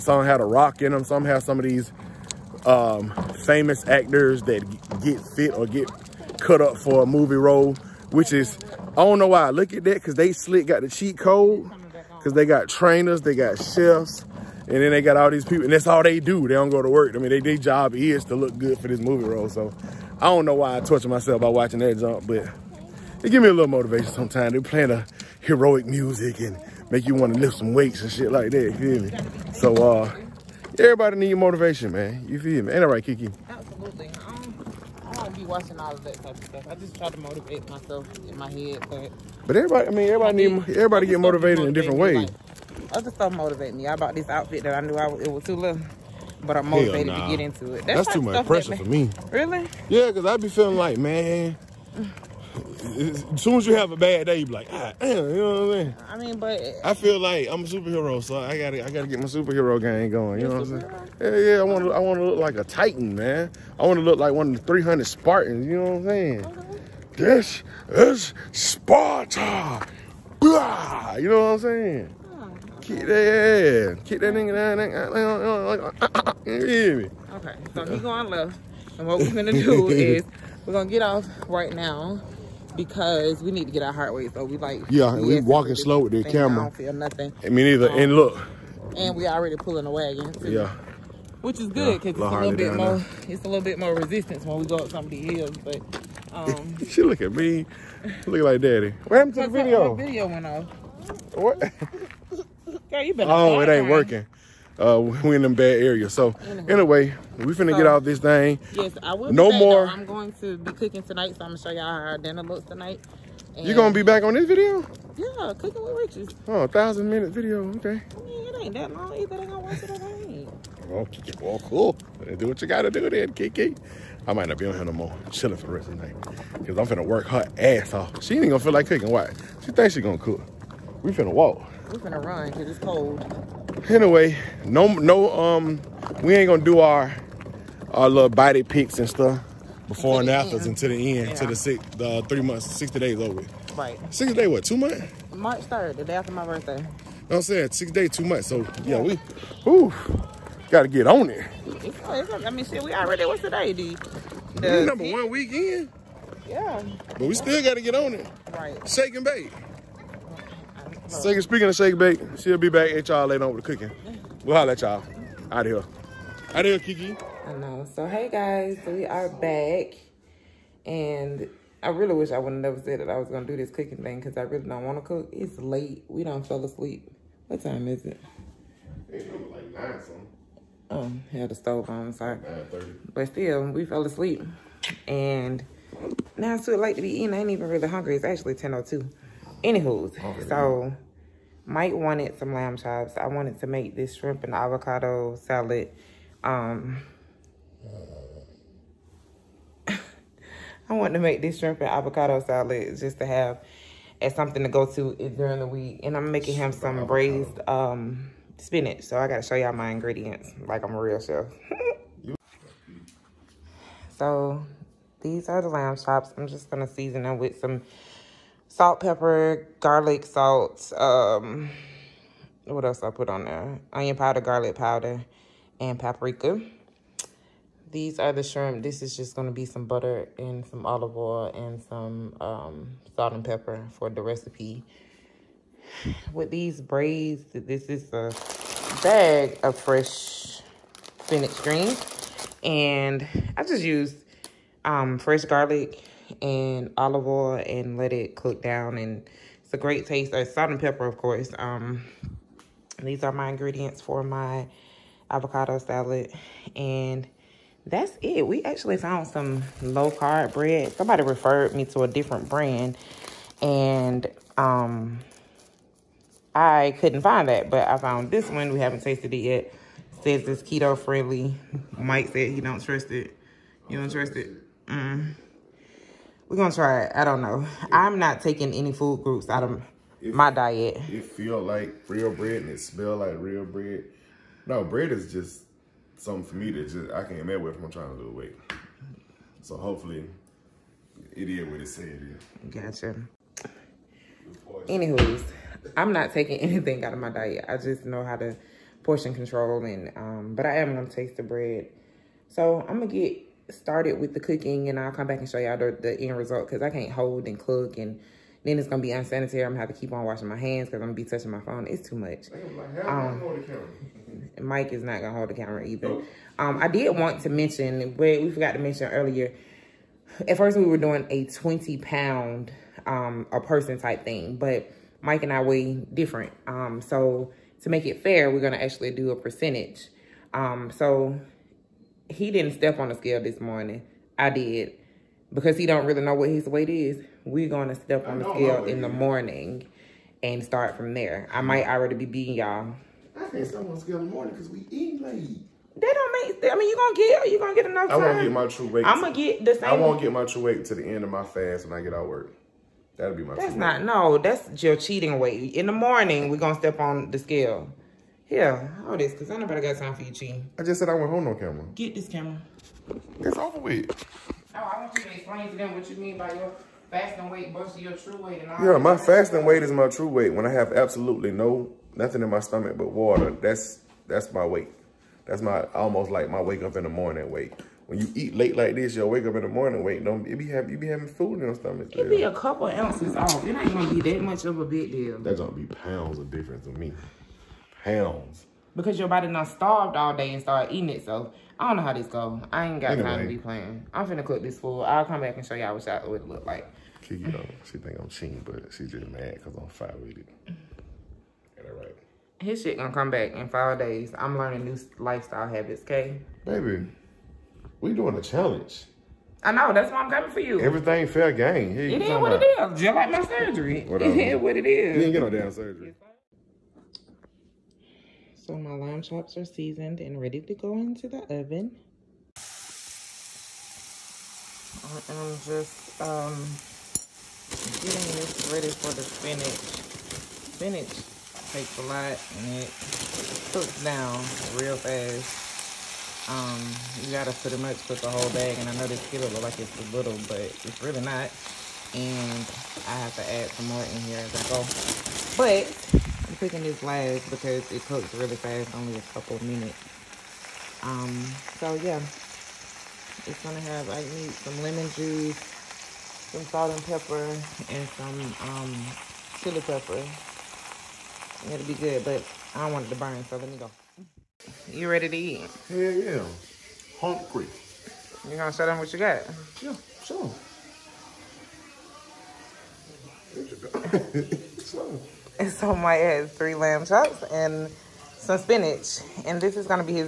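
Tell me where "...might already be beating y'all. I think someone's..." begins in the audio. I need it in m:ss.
5:41.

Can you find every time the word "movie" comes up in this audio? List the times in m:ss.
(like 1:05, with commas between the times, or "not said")
0:07, 0:18.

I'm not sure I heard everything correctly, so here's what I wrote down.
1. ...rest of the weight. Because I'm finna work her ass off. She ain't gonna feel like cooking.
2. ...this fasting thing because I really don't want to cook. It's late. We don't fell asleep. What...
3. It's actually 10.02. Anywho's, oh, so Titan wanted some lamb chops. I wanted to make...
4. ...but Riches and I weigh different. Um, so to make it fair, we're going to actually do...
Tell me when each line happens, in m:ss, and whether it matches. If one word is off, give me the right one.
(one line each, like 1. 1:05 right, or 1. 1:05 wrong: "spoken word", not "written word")
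1. 2:05 wrong: "night", not "weight"
2. 2:53 wrong: "cooking", not "fasting"
3. 3:08 wrong: "Mike", not "Titan"
4. 5:24 wrong: "Mike", not "Riches".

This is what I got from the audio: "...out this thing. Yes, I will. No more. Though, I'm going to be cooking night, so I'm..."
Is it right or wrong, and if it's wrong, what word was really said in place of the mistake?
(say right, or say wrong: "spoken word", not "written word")
wrong: "tonight", not "night".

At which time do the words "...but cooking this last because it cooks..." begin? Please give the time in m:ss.
7:25.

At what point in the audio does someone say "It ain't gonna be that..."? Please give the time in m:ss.
6:23.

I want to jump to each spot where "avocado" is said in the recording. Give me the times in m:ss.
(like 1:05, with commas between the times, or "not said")
3:14, 3:21, 4:15.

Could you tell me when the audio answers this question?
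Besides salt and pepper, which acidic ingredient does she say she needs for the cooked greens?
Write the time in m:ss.
7:34.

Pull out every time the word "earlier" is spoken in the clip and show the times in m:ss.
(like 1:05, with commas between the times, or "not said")
5:19.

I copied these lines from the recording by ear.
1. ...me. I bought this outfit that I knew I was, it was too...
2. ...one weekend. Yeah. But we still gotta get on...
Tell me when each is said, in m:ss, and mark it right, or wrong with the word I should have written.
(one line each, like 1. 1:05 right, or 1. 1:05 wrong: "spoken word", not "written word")
1. 0:43 right
2. 2:35 right.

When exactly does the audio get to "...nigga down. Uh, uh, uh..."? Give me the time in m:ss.
1:14.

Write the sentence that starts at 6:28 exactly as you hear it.
Because your body not starved all day and start eating it.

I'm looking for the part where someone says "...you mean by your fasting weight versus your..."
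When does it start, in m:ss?
6:06.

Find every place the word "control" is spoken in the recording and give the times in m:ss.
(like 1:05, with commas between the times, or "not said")
4:59.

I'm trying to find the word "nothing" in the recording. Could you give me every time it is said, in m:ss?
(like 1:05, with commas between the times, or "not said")
1:26, 6:12.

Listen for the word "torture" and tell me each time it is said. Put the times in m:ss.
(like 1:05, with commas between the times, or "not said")
0:20.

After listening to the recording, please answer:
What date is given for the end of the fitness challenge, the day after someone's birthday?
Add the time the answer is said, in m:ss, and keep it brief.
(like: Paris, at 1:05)
March 3, at 2:25.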